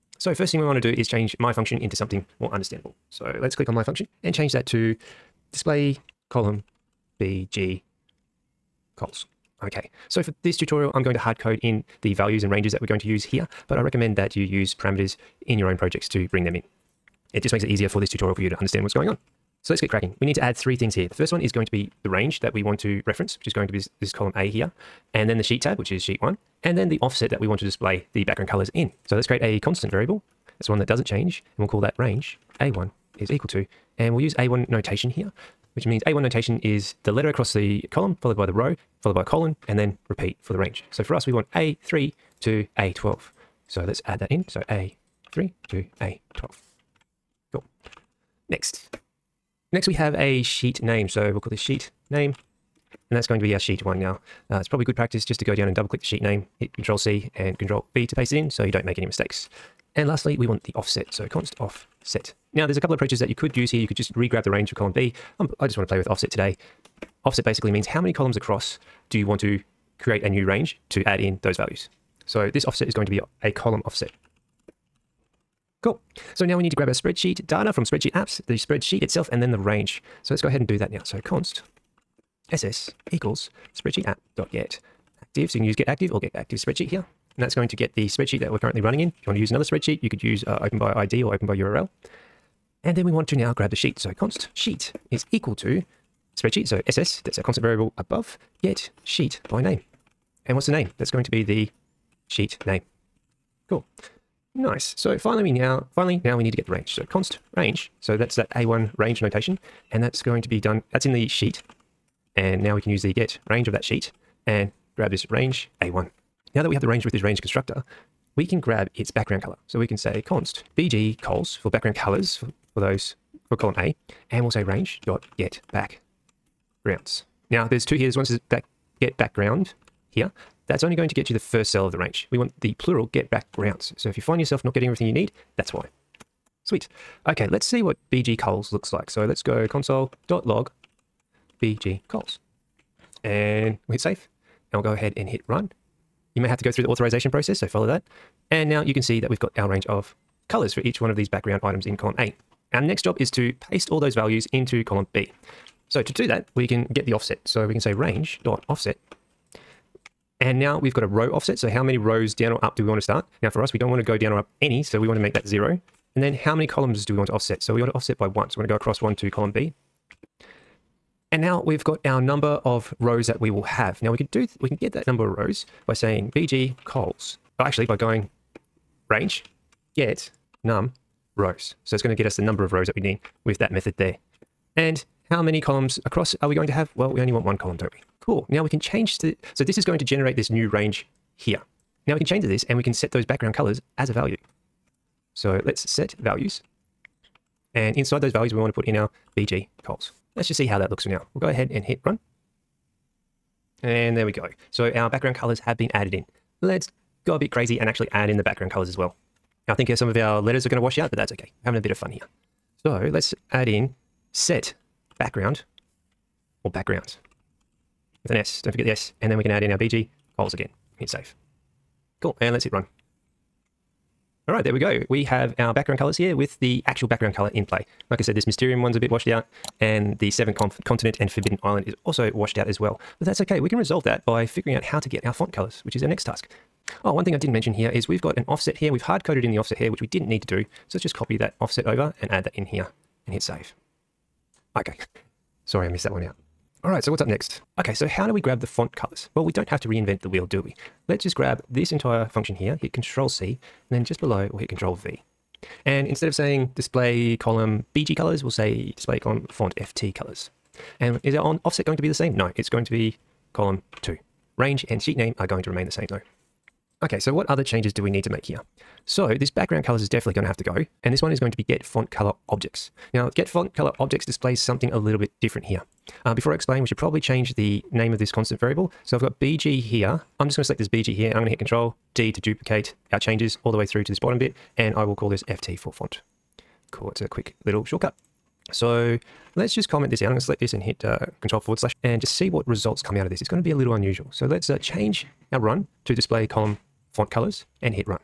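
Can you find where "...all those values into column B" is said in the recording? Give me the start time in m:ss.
2:33.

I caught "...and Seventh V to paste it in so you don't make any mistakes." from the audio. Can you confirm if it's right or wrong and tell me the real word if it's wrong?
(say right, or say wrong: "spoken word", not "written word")
wrong: "Control", not "Seventh".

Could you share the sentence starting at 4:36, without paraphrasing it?
Uh, before I explain, we should probably change the name of this constant variable.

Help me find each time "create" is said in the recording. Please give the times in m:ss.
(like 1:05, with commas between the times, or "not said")
0:29, 1:09.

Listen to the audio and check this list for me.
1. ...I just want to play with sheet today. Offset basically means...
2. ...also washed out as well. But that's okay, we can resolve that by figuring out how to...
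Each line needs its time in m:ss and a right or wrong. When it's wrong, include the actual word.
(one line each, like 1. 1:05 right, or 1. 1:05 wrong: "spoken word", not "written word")
1. 1:05 wrong: "offset", not "sheet"
2. 3:52 right.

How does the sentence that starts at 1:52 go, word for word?
And now we can use the get range of that sheet and grab this range A1.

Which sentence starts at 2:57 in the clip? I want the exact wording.
Oh, actually by going range get num rows.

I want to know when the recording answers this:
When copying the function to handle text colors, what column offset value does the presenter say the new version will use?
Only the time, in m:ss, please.
4:23.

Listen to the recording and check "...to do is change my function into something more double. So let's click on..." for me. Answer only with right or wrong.
wrong.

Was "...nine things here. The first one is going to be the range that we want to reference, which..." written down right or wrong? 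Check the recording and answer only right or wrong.
wrong.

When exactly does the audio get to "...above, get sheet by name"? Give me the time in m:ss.
1:37.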